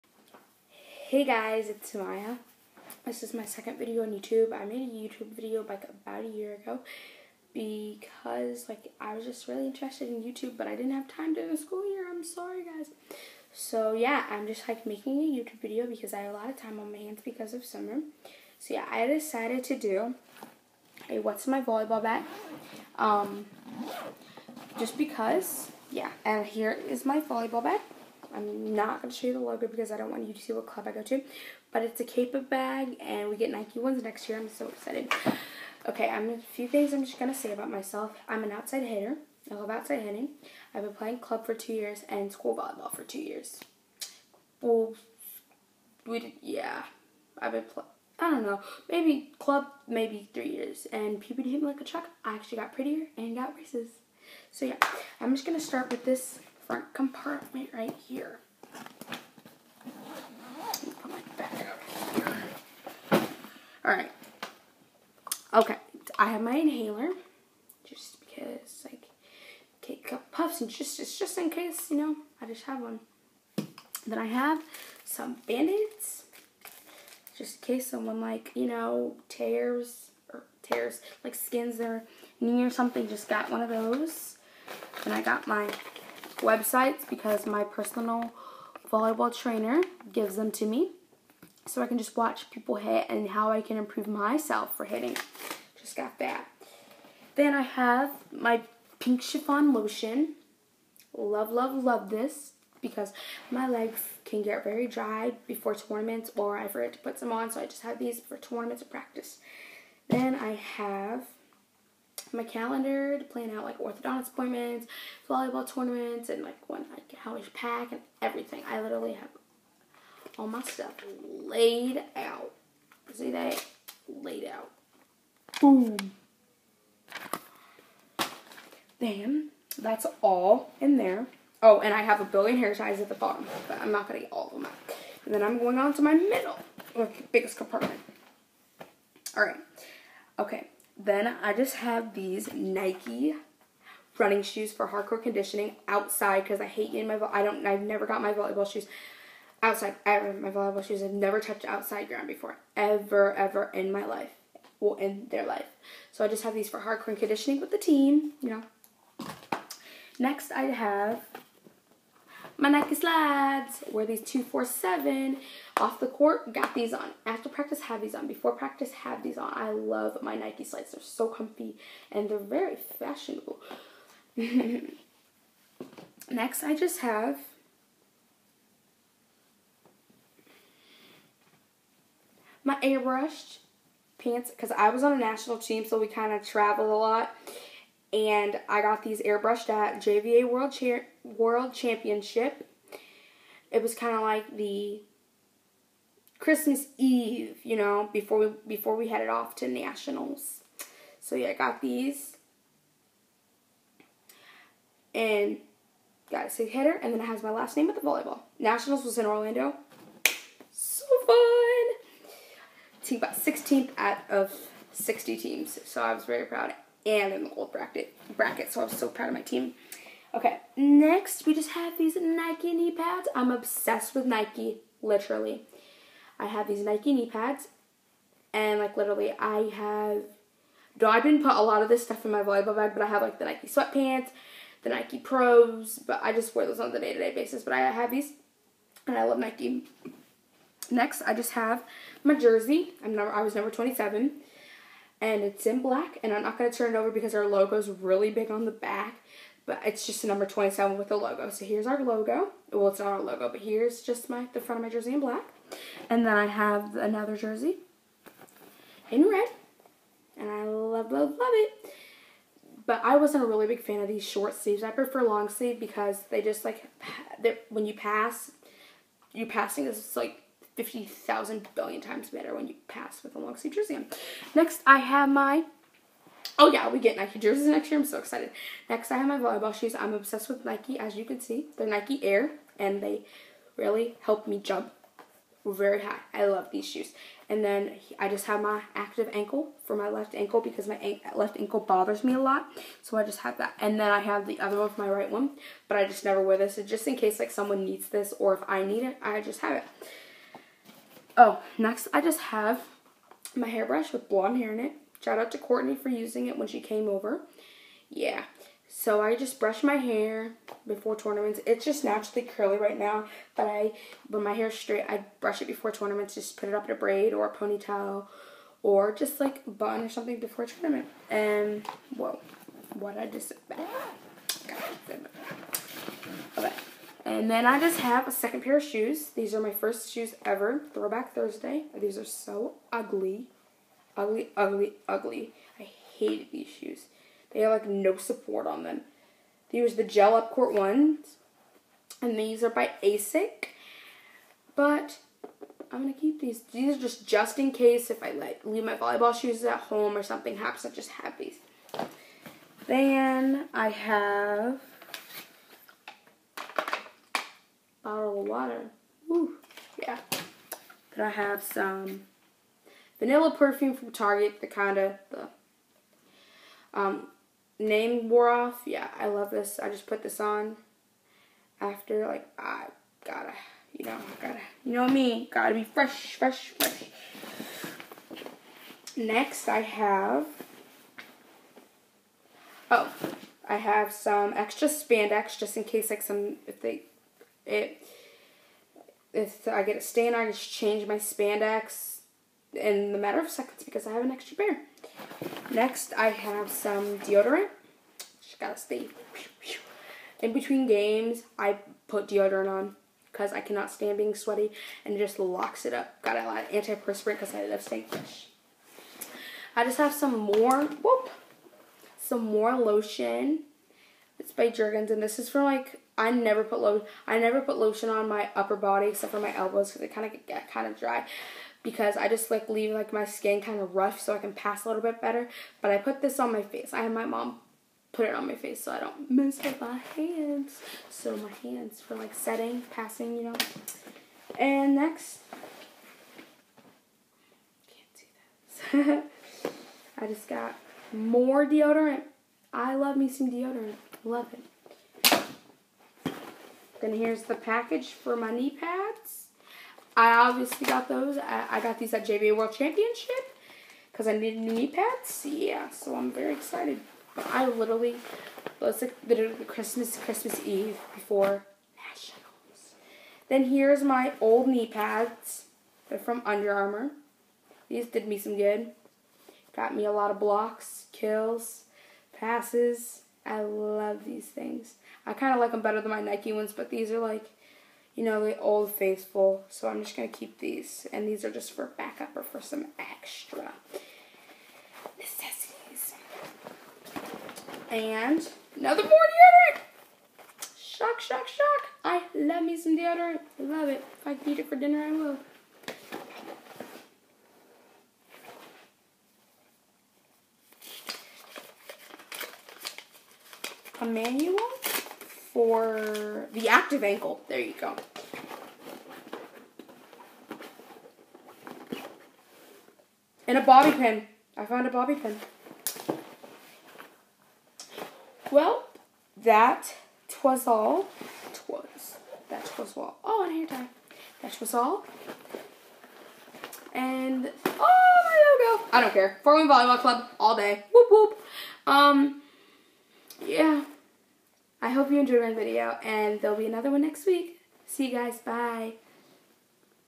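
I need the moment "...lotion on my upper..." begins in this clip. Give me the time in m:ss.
6:57.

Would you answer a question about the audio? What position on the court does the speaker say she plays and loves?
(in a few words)
Outside hitter.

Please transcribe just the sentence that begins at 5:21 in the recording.
And, whoa, what I just, ah, okay.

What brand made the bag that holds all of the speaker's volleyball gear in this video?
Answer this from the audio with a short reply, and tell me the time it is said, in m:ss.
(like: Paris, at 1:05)
Cape, at 0:32.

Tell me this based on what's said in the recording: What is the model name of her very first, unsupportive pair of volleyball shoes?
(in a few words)
Gel Up Court.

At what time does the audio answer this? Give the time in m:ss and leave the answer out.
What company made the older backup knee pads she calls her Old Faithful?
7:46.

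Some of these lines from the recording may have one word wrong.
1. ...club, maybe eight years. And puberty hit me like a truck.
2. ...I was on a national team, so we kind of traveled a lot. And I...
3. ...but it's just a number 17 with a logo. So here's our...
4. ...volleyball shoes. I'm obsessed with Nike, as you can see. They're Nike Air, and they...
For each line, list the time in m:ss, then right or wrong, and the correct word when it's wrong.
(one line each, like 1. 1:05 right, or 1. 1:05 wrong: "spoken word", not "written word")
1. 0:49 wrong: "three", not "eight"
2. 3:04 right
3. 4:09 wrong: "27", not "17"
4. 4:39 right.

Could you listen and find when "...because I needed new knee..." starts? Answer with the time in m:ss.
7:34.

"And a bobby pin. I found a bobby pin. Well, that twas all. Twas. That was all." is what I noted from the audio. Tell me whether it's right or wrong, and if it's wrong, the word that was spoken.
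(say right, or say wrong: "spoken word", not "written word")
right.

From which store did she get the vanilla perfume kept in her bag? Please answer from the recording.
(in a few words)
Target.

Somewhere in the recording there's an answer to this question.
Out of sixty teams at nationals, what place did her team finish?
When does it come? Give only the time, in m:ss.
3:33.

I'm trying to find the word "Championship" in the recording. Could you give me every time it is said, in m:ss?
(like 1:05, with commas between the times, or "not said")
3:11, 7:32.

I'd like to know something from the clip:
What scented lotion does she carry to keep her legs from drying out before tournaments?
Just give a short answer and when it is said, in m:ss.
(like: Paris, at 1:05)
Pink chiffon, at 1:38.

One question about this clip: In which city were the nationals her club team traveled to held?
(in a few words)
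Orlando.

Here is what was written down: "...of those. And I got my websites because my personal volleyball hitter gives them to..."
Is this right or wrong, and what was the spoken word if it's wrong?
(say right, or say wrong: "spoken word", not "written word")
wrong: "trainer", not "hitter".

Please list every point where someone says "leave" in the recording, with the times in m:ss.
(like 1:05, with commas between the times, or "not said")
5:48, 7:02.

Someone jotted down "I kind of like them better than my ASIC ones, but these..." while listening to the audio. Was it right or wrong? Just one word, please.
wrong.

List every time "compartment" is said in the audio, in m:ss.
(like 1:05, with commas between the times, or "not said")
0:56, 2:17.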